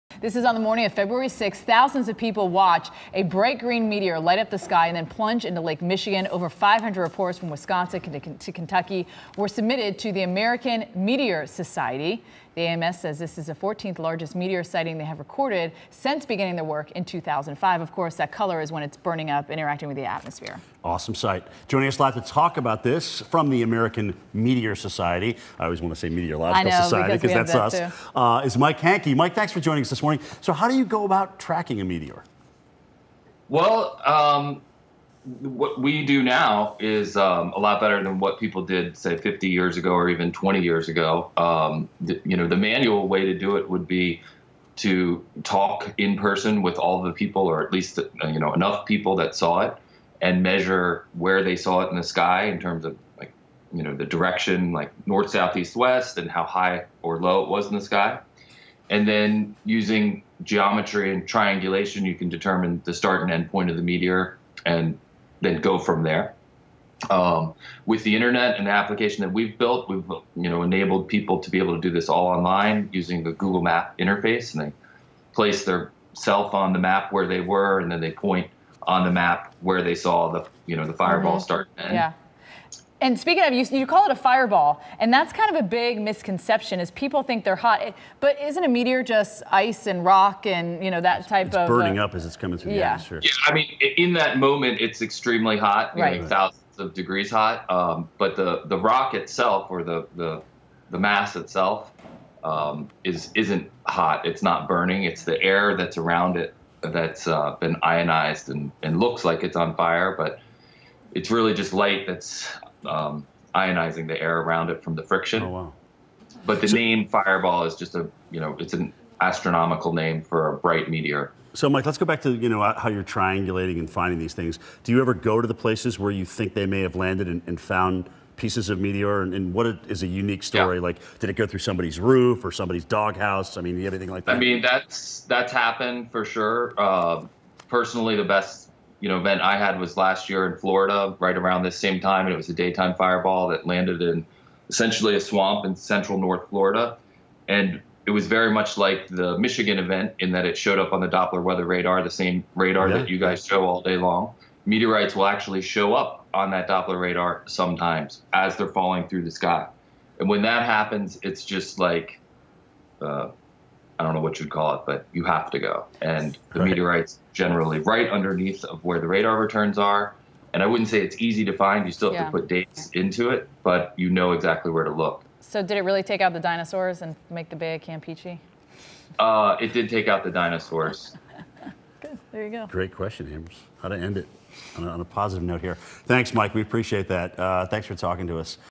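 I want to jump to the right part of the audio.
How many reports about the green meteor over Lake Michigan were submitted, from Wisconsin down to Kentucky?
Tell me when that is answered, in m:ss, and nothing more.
0:06.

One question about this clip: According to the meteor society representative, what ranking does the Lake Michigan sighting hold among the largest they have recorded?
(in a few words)
14th largest.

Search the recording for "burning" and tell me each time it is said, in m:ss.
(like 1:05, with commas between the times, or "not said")
0:18, 1:31, 1:44.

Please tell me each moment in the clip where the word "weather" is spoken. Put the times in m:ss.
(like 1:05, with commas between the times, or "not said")
2:31.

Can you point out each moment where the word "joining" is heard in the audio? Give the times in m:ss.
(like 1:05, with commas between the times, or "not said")
0:21, 0:29.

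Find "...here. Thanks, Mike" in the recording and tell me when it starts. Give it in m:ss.
3:05.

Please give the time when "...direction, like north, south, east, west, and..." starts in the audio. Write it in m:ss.
0:54.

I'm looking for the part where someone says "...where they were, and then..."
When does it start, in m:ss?
1:17.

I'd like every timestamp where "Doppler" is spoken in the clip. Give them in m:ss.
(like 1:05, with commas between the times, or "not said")
2:31, 2:36.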